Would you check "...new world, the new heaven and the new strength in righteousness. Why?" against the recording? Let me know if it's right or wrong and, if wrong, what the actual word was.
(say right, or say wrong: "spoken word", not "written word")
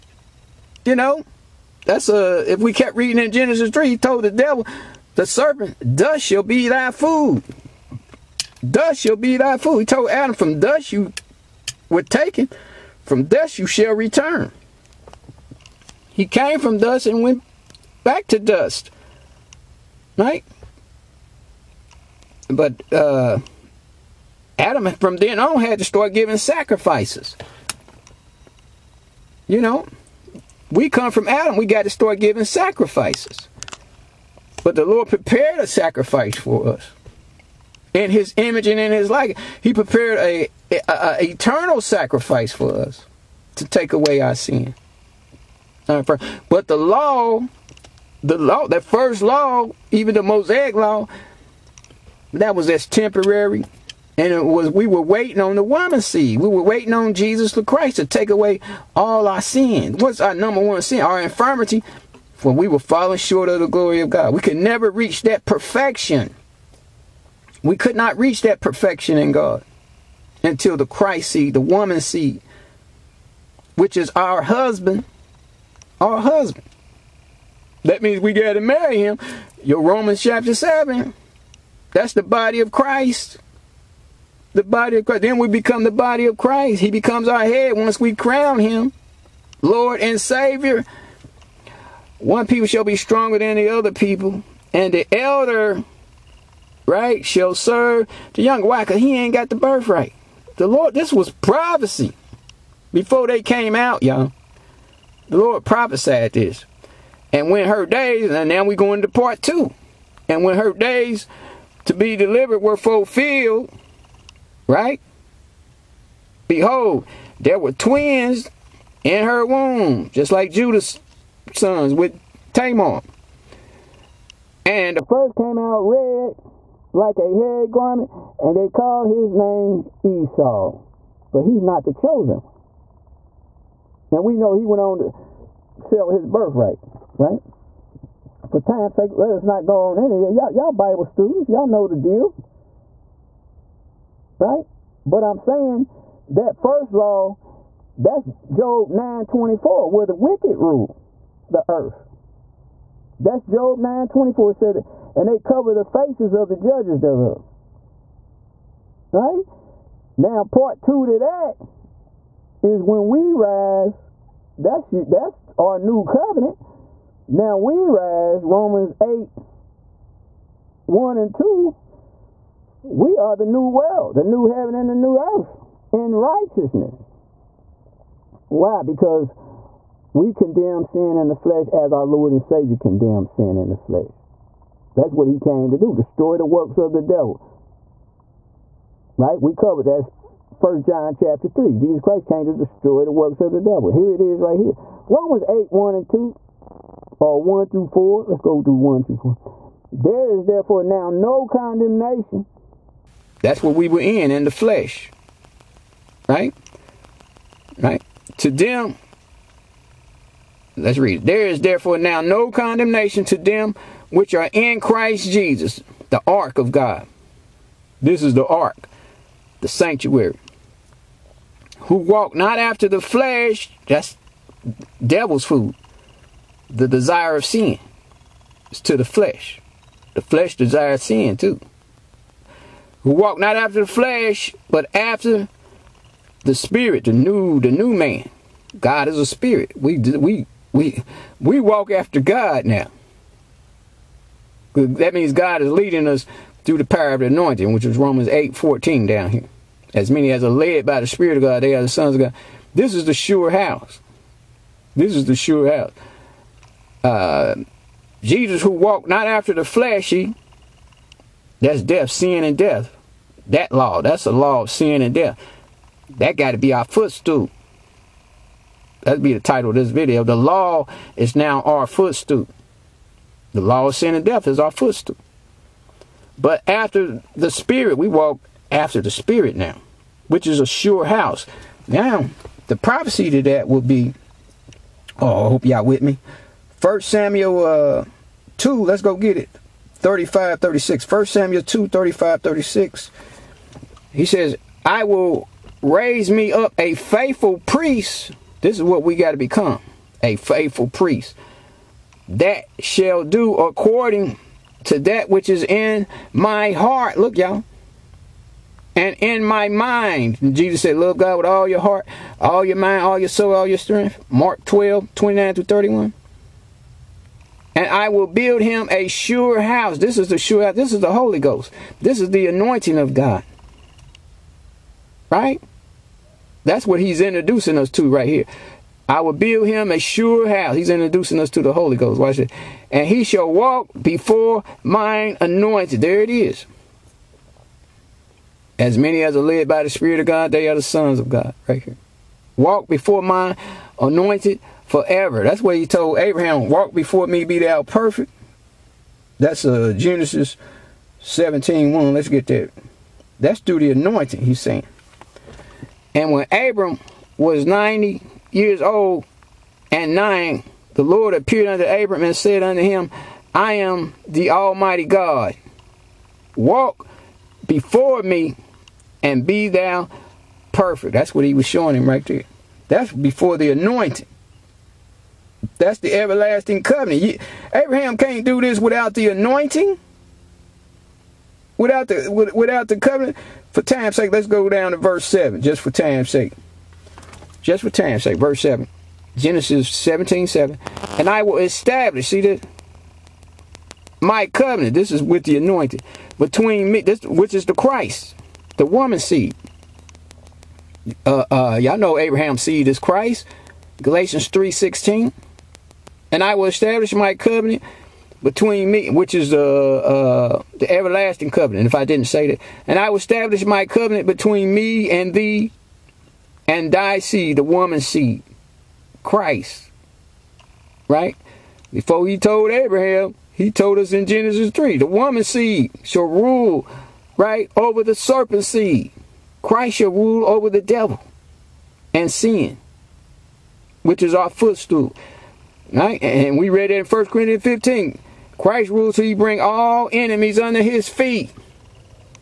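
wrong: "earth", not "strength".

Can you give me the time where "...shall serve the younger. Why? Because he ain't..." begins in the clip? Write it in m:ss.
1:37.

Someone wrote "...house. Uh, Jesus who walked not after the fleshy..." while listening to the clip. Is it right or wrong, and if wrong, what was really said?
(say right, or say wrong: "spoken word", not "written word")
right.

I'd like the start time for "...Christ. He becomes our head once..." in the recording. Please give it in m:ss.
1:26.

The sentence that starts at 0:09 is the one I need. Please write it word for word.
He told Adam, from dust you were taken, from dust you shall return.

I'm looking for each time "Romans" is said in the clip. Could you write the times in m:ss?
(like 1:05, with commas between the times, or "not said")
1:19, 2:48, 3:15, 4:07.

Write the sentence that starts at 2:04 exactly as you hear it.
And the first came out red like a hairy garment, and they called his name Esau.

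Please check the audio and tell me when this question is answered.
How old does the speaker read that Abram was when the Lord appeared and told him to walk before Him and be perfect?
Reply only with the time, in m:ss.
5:57.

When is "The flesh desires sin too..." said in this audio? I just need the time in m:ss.
3:50.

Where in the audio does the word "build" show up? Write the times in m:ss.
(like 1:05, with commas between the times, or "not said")
5:18, 5:29.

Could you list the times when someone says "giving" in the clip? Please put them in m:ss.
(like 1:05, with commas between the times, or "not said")
0:26, 0:32.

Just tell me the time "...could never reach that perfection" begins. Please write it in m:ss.
1:04.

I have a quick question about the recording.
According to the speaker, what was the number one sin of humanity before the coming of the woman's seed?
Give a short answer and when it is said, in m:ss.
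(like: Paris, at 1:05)
Our infirmity, at 1:01.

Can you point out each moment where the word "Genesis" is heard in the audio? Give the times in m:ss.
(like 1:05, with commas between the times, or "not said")
0:03, 5:49, 6:29, 7:04.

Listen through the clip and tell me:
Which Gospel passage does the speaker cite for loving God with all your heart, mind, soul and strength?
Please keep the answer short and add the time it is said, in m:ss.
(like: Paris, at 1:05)
Mark 12:29-31, at 5:14.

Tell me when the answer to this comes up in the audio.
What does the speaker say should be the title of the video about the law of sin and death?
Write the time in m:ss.
4:30.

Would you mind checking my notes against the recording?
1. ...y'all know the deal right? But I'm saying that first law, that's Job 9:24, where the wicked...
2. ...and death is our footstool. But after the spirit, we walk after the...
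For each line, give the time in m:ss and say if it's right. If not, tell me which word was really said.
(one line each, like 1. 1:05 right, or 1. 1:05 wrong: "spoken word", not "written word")
1. 2:21 right
2. 4:34 right.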